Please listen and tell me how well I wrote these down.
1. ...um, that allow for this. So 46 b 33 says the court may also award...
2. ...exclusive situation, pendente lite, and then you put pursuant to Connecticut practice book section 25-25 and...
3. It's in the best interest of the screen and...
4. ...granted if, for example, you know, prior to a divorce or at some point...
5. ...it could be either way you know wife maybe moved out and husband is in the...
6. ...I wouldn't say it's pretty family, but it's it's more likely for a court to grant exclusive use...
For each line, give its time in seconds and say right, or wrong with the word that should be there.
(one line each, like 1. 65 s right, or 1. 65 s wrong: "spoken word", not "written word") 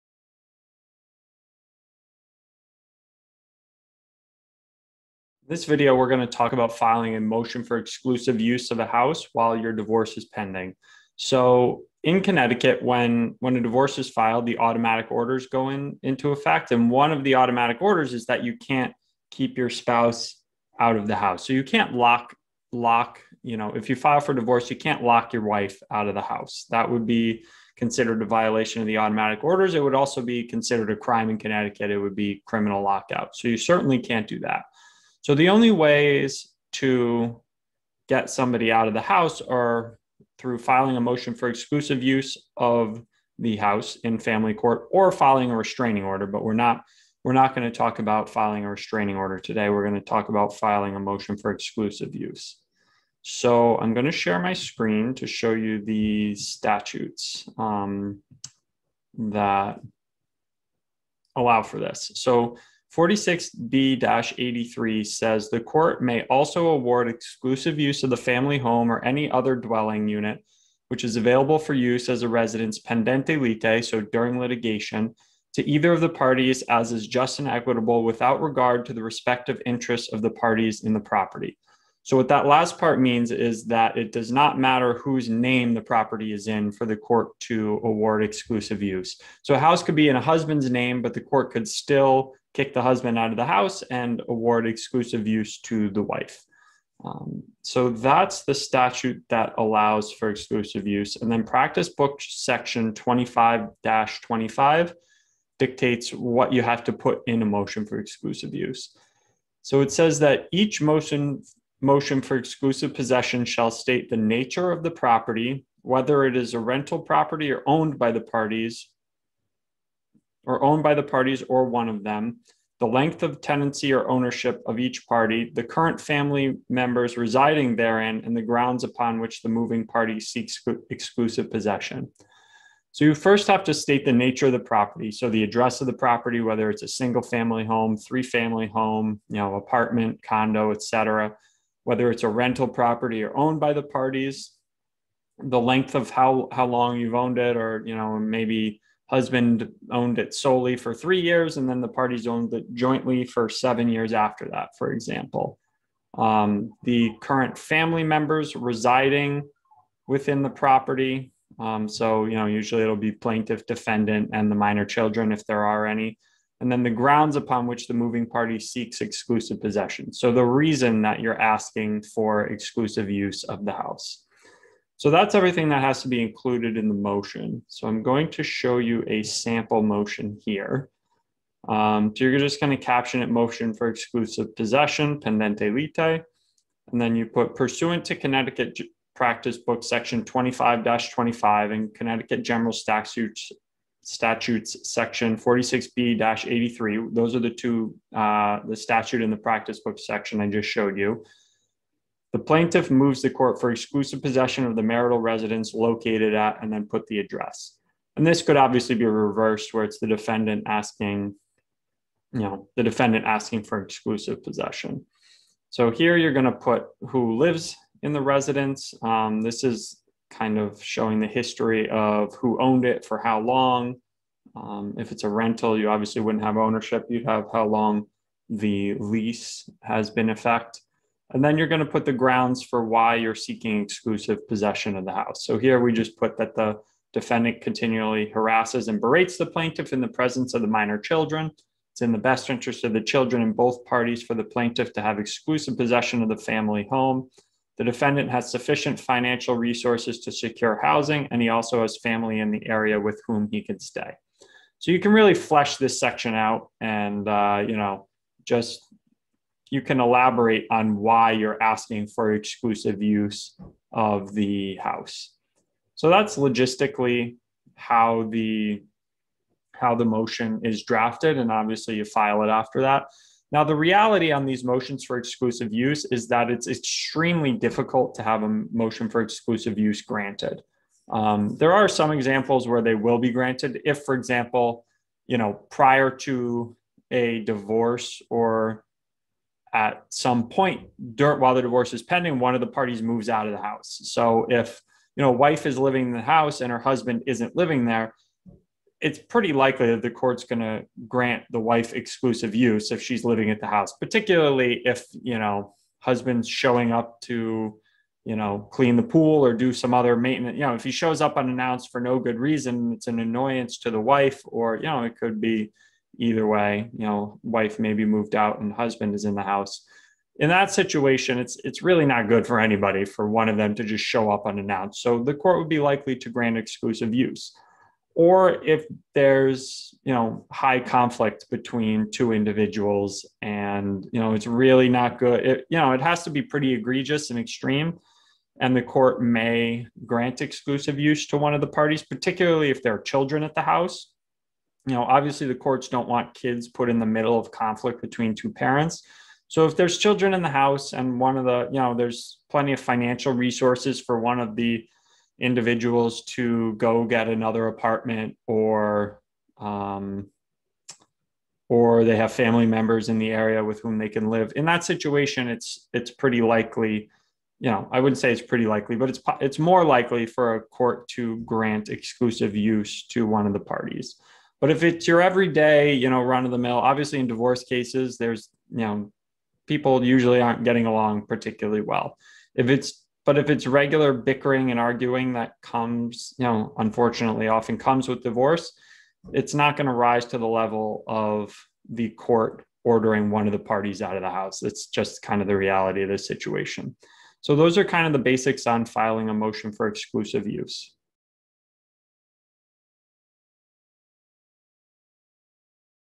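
1. 57 s wrong: "83", not "33"
2. 183 s wrong: "possession", not "situation"
3. 241 s wrong: "children", not "screen"
4. 283 s right
5. 315 s right
6. 367 s wrong: "likely", not "family".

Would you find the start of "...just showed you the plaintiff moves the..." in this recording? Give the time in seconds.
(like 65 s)
200 s.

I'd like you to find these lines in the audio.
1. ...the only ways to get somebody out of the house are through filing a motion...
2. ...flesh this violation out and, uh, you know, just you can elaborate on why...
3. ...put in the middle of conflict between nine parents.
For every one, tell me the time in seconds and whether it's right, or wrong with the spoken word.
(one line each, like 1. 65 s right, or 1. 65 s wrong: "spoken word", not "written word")
1. 35 s right
2. 255 s wrong: "section", not "violation"
3. 346 s wrong: "two", not "nine".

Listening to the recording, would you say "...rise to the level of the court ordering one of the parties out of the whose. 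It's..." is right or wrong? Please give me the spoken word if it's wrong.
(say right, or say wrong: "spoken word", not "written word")
wrong: "house", not "whose".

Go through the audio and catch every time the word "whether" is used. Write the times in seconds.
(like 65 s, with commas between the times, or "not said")
115 s, 136 s, 141 s.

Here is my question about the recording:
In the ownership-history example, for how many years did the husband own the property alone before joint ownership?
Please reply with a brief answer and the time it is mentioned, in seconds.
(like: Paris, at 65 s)
3, at 150 s.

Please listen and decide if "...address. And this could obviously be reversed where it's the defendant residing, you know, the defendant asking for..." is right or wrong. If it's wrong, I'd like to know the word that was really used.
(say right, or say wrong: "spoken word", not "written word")
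wrong: "asking", not "residing".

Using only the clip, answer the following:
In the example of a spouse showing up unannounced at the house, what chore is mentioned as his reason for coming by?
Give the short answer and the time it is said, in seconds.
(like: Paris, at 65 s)
clean the pool, at 308 s.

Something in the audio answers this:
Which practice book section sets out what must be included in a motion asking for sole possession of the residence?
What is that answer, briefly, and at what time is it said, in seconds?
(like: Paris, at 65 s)
25-25, at 102 s.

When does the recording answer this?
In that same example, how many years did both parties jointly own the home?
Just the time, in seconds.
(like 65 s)
153 s.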